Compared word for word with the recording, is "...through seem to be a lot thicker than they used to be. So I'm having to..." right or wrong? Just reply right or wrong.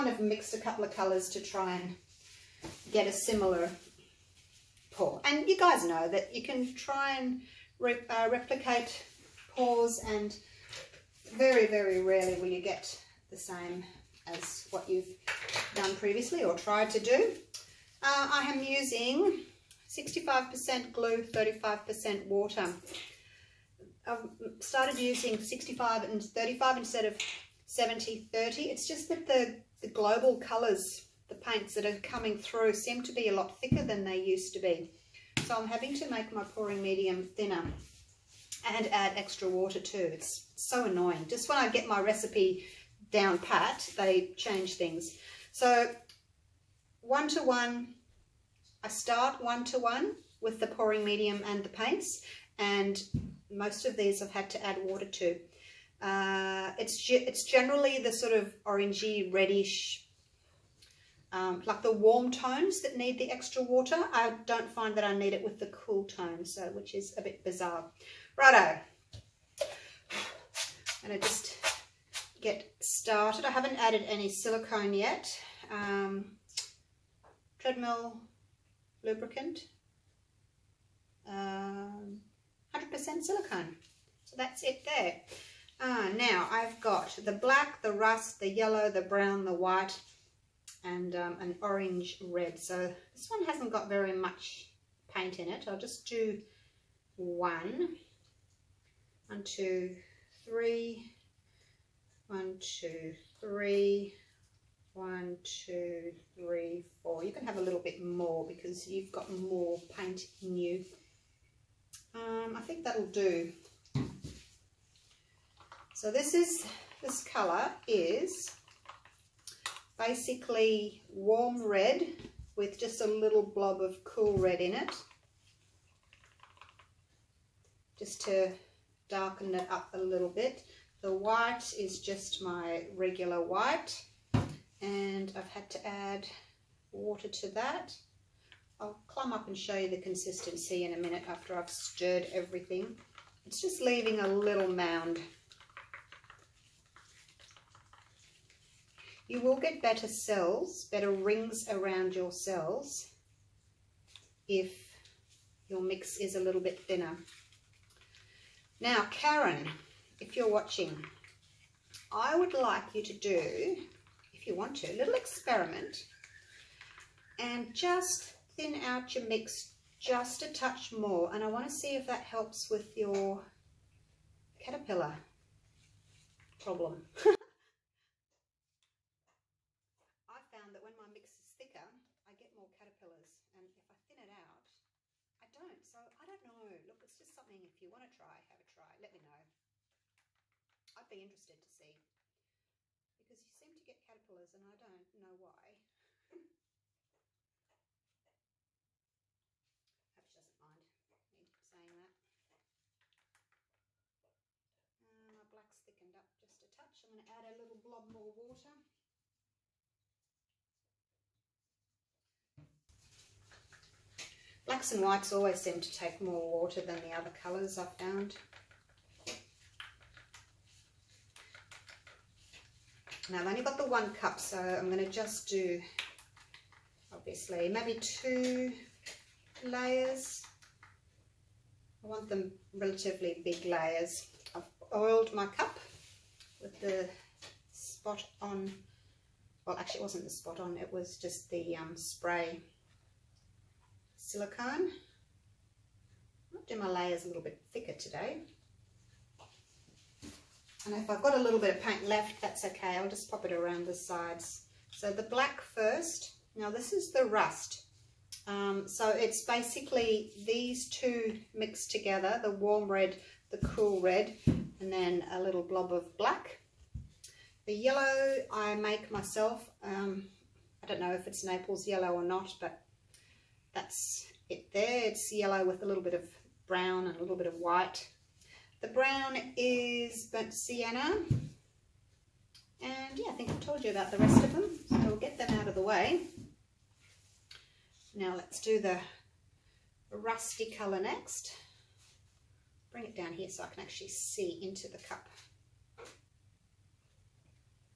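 right.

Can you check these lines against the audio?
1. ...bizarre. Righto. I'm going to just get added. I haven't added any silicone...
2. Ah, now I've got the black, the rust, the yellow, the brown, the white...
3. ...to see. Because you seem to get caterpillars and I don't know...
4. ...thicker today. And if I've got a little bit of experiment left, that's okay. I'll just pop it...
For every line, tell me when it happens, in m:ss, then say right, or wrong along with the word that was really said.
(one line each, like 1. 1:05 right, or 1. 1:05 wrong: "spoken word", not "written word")
1. 1:07 wrong: "started", not "added"
2. 1:25 right
3. 3:11 right
4. 4:07 wrong: "paint", not "experiment".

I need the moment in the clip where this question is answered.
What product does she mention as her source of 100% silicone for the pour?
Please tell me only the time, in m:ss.
1:17.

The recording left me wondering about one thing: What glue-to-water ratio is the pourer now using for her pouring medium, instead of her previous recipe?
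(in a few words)
65% glue, 35% water.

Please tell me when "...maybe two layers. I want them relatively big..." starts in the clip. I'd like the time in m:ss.
3:47.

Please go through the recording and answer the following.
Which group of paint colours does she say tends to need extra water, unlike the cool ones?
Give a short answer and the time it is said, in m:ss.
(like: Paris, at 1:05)
Warm tones, at 1:01.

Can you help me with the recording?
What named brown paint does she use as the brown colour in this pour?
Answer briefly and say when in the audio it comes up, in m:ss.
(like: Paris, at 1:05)
Burnt sienna, at 4:40.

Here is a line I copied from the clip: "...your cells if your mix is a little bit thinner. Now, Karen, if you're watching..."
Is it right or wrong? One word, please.
right.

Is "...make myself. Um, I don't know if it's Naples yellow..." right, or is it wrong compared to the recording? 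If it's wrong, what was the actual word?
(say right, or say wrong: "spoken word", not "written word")
right.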